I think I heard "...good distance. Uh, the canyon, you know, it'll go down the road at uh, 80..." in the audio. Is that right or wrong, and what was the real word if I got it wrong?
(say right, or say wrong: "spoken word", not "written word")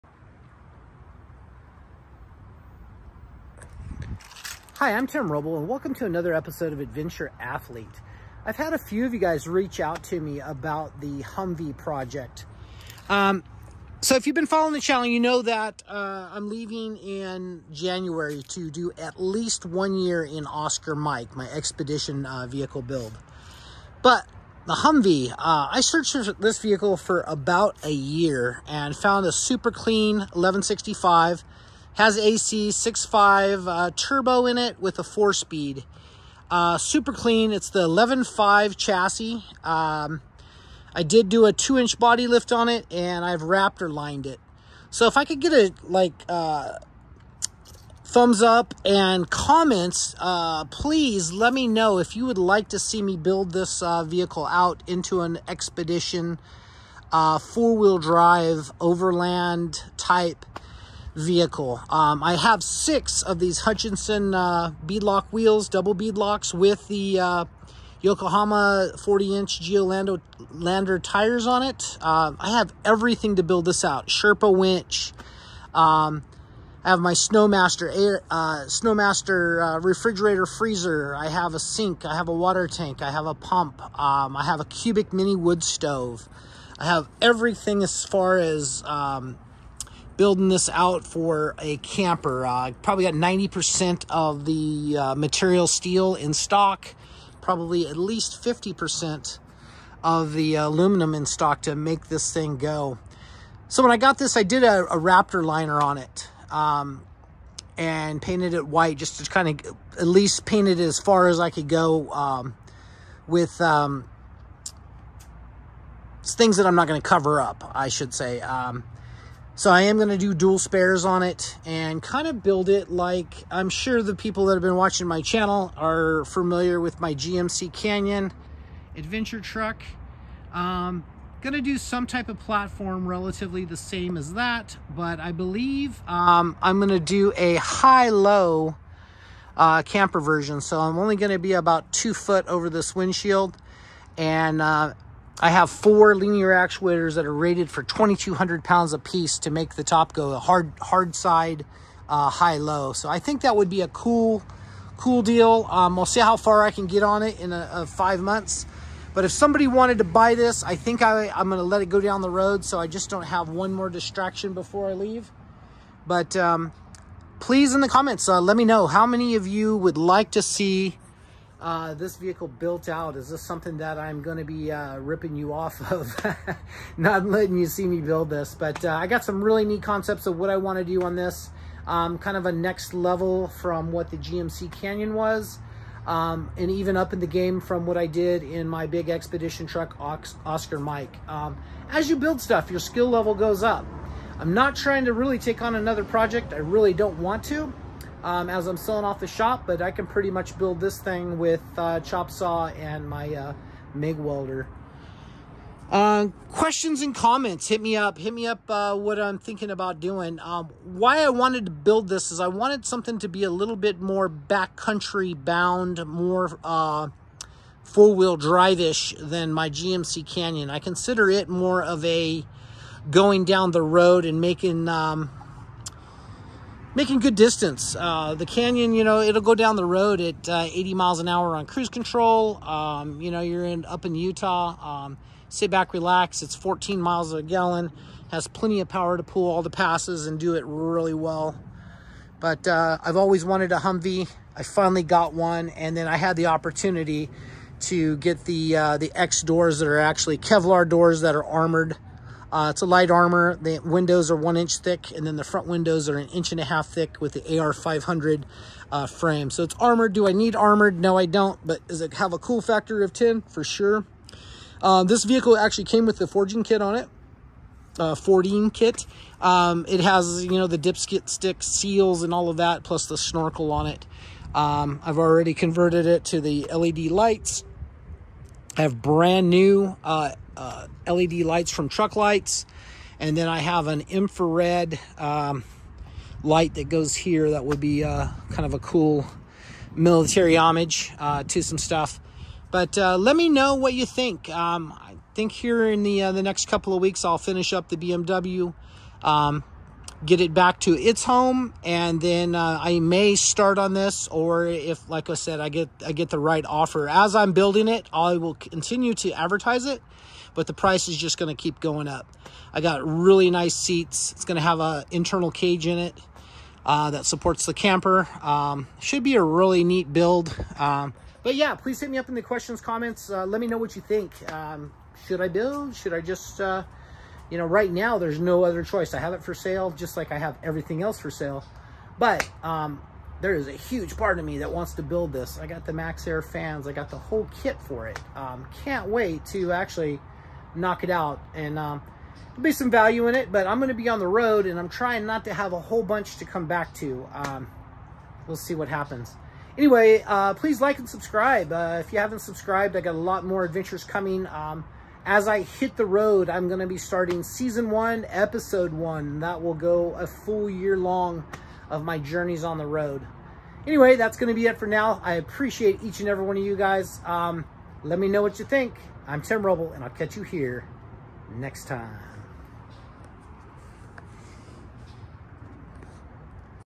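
right.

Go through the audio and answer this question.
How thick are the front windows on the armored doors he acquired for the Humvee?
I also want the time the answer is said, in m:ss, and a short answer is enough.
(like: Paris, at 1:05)
an inch and a half, at 4:16.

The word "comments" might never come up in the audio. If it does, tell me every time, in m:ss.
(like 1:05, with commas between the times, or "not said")
0:49, 2:47, 3:27, 5:22.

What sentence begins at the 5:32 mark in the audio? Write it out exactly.
But um, there is a huge part of me that wants to build this.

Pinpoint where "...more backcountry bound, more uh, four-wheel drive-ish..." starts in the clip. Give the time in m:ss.
3:33.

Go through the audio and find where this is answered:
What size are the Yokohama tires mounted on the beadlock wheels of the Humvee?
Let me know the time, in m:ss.
1:08.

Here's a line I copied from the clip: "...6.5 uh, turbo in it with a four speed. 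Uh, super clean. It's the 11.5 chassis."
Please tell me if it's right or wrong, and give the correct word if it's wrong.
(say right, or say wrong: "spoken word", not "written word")
right.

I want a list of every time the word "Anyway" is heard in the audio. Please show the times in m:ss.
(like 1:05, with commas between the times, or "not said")
5:49, 6:03.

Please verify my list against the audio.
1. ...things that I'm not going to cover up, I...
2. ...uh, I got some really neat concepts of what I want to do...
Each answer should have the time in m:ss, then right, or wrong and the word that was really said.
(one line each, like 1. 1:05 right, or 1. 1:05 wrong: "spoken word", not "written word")
1. 1:56 right
2. 2:58 right.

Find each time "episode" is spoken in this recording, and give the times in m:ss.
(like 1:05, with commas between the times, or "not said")
0:06, 5:58.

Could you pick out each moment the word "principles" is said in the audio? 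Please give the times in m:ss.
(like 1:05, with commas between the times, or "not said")
not said.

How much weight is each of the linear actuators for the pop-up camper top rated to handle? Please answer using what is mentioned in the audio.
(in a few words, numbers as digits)
2,200 pounds.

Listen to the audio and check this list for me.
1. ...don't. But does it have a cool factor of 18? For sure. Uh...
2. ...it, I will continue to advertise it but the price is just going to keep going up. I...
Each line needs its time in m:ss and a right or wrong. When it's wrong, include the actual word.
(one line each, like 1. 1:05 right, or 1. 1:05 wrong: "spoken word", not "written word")
1. 4:21 wrong: "10", not "18"
2. 5:07 right.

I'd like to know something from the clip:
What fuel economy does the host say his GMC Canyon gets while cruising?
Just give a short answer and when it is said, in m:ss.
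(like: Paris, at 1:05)
14 miles a gallon, at 3:56.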